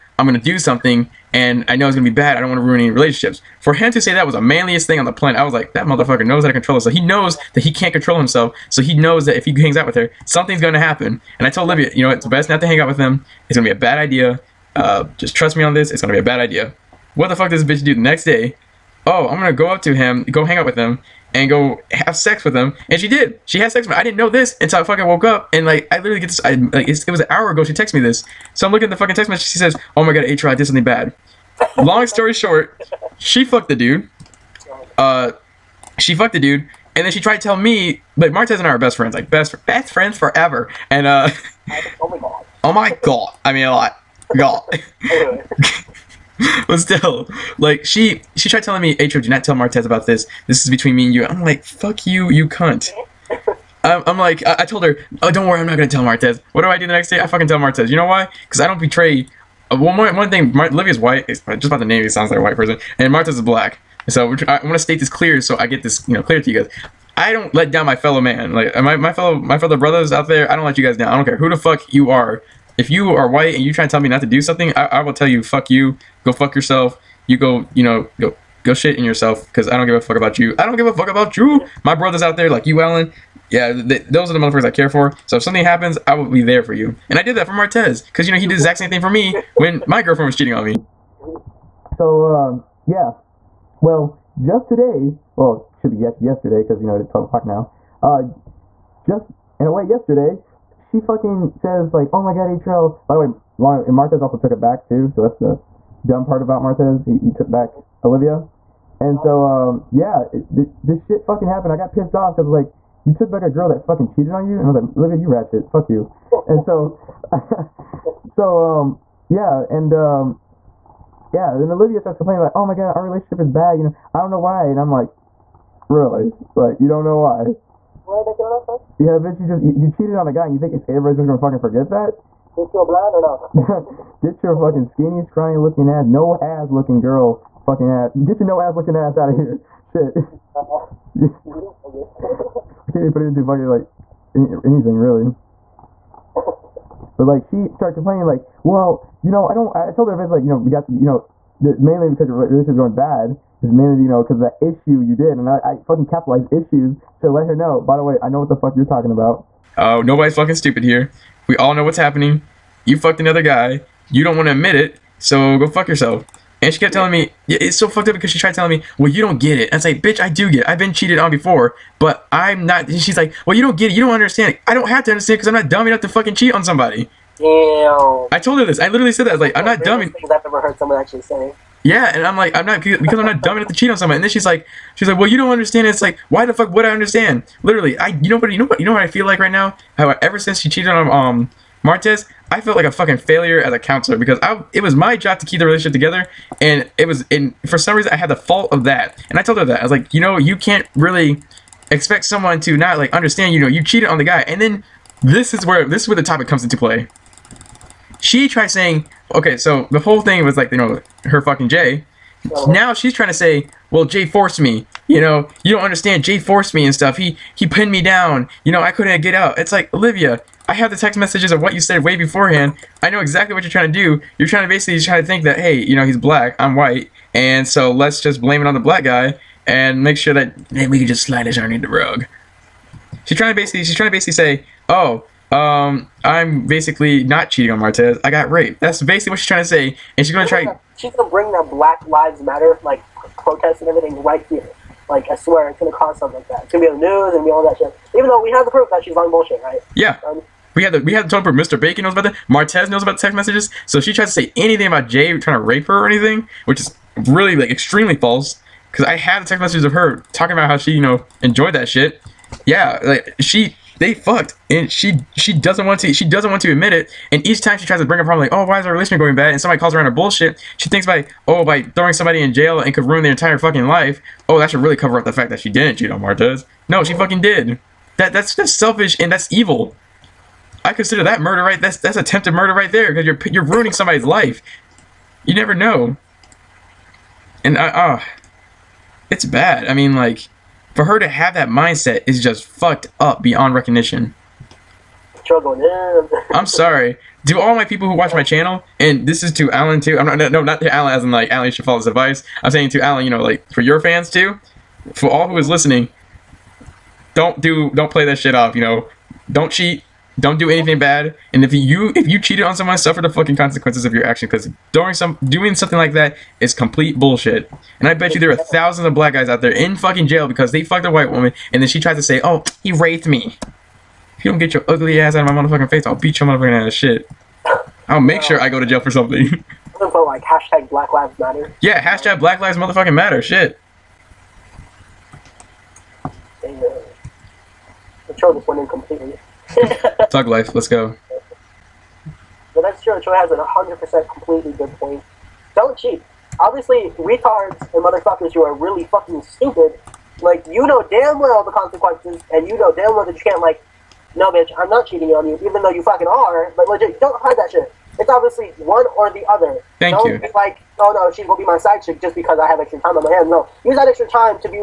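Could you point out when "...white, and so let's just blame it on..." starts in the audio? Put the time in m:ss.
3:46.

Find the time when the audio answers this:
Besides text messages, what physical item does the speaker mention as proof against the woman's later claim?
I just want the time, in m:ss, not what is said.
4:11.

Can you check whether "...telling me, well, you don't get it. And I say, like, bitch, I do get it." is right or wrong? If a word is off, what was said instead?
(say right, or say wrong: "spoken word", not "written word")
right.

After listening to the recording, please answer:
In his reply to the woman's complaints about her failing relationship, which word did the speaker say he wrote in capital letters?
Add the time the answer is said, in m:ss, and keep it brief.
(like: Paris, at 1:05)
issues, at 2:36.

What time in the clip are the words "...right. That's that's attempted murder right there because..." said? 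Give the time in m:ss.
4:41.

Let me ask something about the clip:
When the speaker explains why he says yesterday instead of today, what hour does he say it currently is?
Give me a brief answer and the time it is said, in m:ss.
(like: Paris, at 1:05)
12 o'clock, at 1:37.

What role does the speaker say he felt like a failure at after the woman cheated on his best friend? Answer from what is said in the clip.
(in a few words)
counselor.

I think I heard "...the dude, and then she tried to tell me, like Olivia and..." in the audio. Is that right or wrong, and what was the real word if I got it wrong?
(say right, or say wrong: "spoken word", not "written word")
wrong: "Martez", not "Olivia".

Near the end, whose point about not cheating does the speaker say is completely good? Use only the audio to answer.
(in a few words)
Troy.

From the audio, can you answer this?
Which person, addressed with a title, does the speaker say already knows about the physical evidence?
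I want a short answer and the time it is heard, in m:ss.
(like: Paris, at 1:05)
Mr. Bacon, at 4:11.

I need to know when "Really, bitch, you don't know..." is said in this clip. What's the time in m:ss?
2:08.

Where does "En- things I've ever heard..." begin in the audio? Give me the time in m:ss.
3:00.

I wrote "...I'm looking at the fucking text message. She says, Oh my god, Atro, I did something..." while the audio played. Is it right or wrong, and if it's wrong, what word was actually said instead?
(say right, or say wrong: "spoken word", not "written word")
right.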